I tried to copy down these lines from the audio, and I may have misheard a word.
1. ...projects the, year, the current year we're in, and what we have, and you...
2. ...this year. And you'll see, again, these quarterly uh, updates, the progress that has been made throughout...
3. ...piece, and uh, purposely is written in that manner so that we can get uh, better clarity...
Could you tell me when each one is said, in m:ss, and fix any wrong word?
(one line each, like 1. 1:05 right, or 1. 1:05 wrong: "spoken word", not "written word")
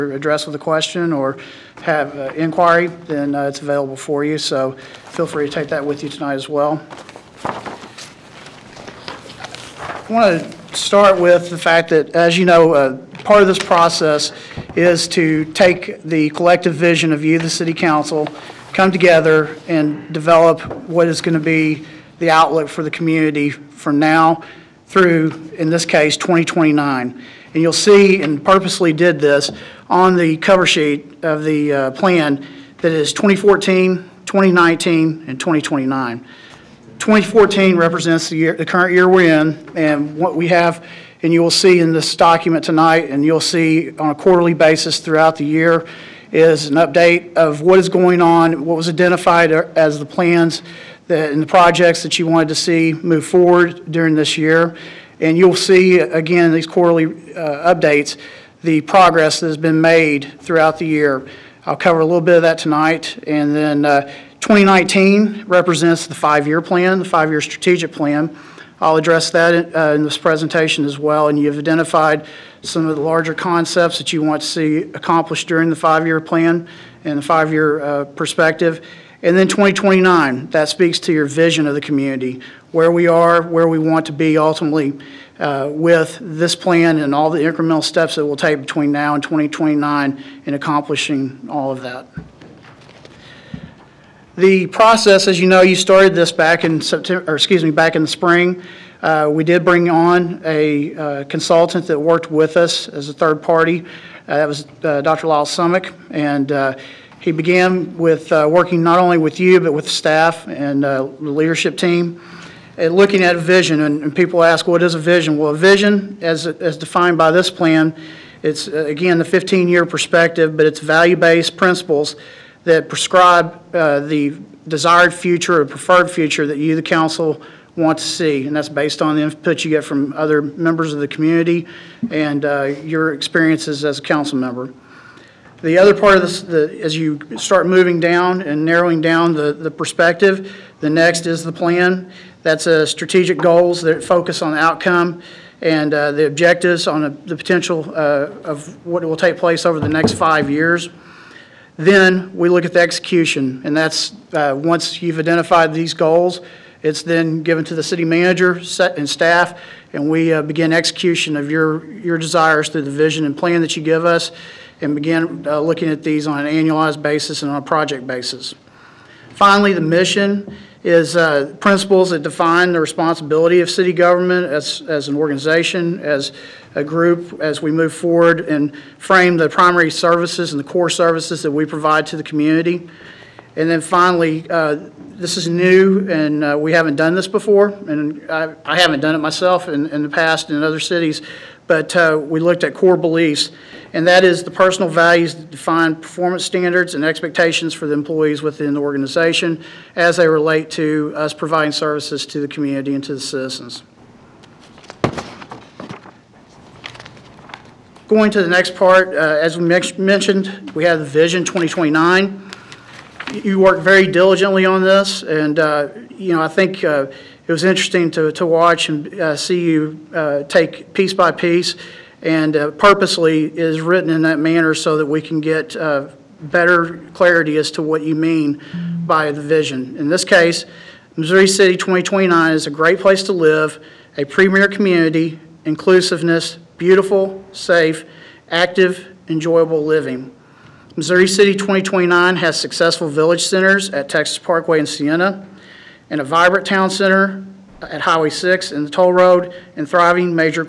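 1. 0:37 wrong: "represents", not "projects"
2. 0:54 right
3. 3:41 right.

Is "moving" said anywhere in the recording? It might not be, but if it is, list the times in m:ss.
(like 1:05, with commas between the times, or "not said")
2:17.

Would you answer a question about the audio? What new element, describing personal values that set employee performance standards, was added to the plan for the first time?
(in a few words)
Core beliefs.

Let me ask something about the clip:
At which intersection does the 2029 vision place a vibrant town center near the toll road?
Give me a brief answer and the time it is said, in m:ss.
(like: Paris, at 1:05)
Highway 6, at 4:08.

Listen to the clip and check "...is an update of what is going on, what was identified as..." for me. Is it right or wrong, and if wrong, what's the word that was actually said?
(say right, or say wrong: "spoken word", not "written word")
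right.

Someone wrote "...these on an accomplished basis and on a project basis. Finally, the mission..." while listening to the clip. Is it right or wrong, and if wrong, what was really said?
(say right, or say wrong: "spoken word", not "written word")
wrong: "annualized", not "accomplished".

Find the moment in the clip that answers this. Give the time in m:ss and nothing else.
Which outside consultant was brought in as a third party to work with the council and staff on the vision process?
1:45.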